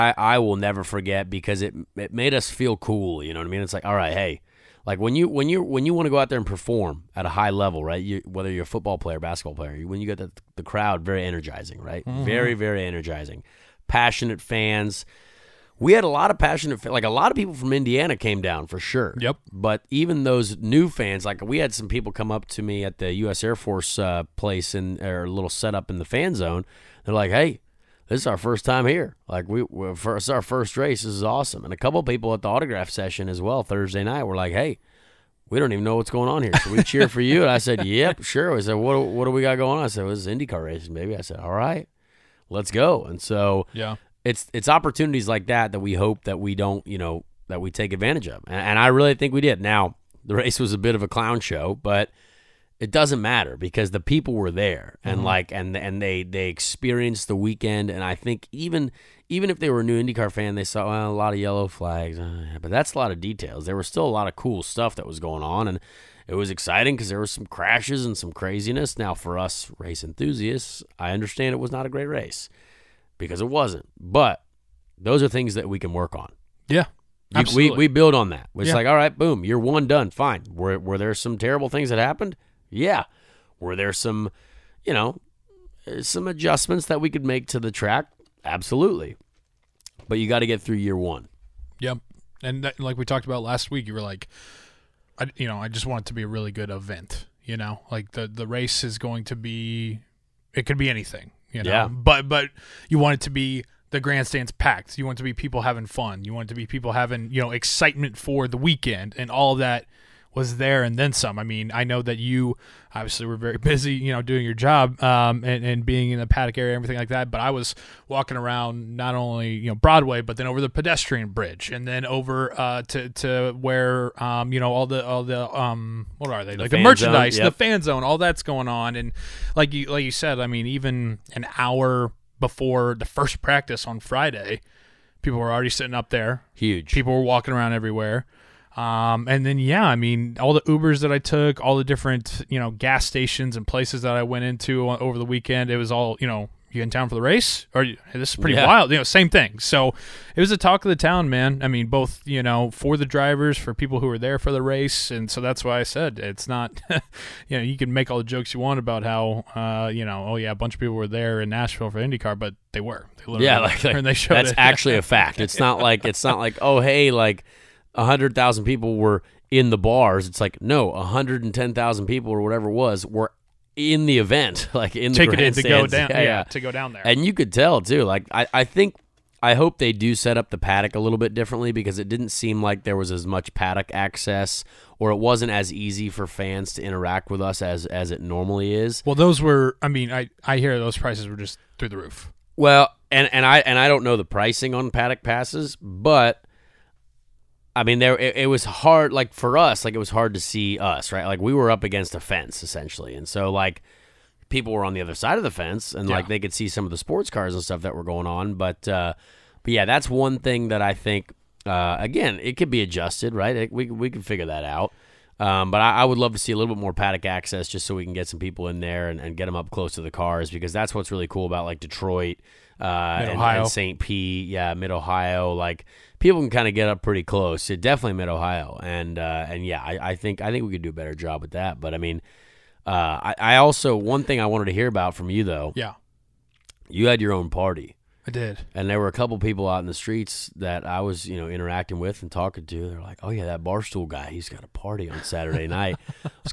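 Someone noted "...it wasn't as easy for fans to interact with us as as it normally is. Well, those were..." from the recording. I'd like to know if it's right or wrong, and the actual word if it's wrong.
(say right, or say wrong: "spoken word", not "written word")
right.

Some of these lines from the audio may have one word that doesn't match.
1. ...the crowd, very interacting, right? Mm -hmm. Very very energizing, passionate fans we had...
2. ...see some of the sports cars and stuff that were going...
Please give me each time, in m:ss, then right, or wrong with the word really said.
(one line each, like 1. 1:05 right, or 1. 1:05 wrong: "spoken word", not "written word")
1. 0:10 wrong: "energizing", not "interacting"
2. 3:26 right.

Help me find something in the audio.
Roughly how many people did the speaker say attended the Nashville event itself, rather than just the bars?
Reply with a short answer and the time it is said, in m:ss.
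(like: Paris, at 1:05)
110,000, at 2:50.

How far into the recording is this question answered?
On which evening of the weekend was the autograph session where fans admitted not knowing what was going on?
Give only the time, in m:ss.
0:33.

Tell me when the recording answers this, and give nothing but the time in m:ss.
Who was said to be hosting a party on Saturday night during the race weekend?
4:03.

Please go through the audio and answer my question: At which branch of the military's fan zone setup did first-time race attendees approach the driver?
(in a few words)
U.S. Air Force.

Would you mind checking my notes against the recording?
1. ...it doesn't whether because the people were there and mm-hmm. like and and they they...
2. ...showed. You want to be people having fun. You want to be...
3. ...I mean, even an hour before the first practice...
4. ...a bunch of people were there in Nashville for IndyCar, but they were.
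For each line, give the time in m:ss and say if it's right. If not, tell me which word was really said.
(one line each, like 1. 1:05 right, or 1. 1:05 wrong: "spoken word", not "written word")
1. 0:52 wrong: "matter", not "whether"
2. 1:44 wrong: "packed", not "showed"
3. 2:10 right
4. 2:40 right.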